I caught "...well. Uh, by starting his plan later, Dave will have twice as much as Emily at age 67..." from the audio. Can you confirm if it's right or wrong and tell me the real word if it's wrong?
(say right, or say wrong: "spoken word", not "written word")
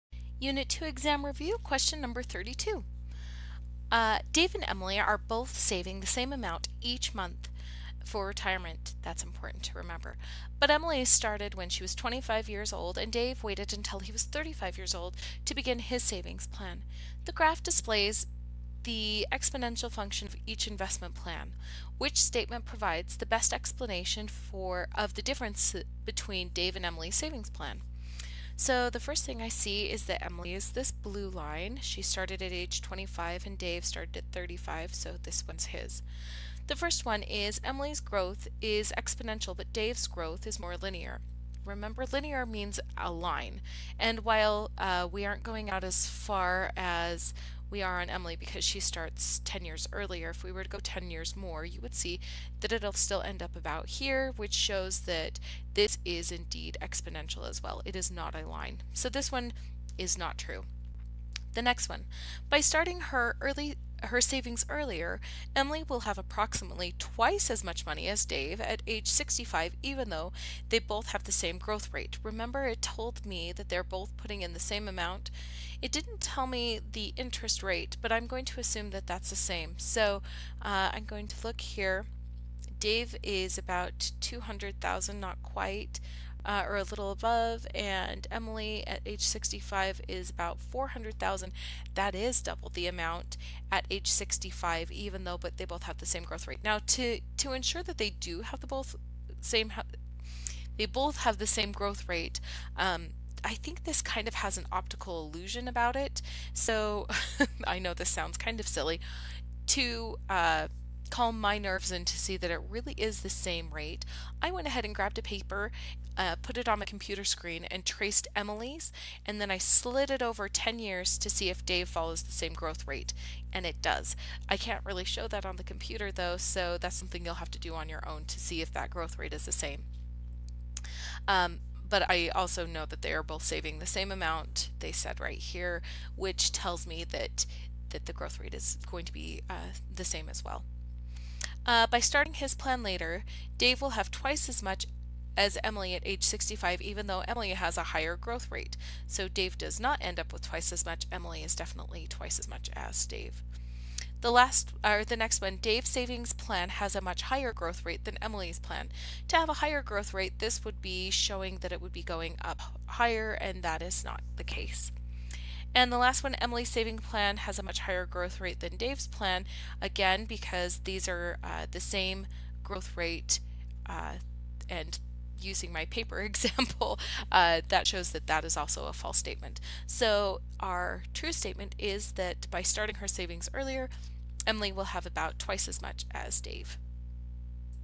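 wrong: "65", not "67".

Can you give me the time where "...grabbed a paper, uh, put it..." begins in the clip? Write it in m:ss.
1:54.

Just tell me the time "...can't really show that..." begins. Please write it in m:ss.
2:04.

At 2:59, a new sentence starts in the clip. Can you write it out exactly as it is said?
So our true statement is that by starting her savings earlier, Emily will have about twice as much as Dave.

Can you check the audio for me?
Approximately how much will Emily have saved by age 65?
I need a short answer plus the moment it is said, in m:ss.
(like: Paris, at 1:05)
400,000, at 1:30.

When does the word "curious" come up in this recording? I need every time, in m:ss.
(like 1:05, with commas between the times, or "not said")
not said.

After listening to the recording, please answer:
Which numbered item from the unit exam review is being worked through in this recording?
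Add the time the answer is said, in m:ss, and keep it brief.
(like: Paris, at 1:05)
32, at 0:01.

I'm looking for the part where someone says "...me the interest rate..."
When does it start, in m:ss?
1:16.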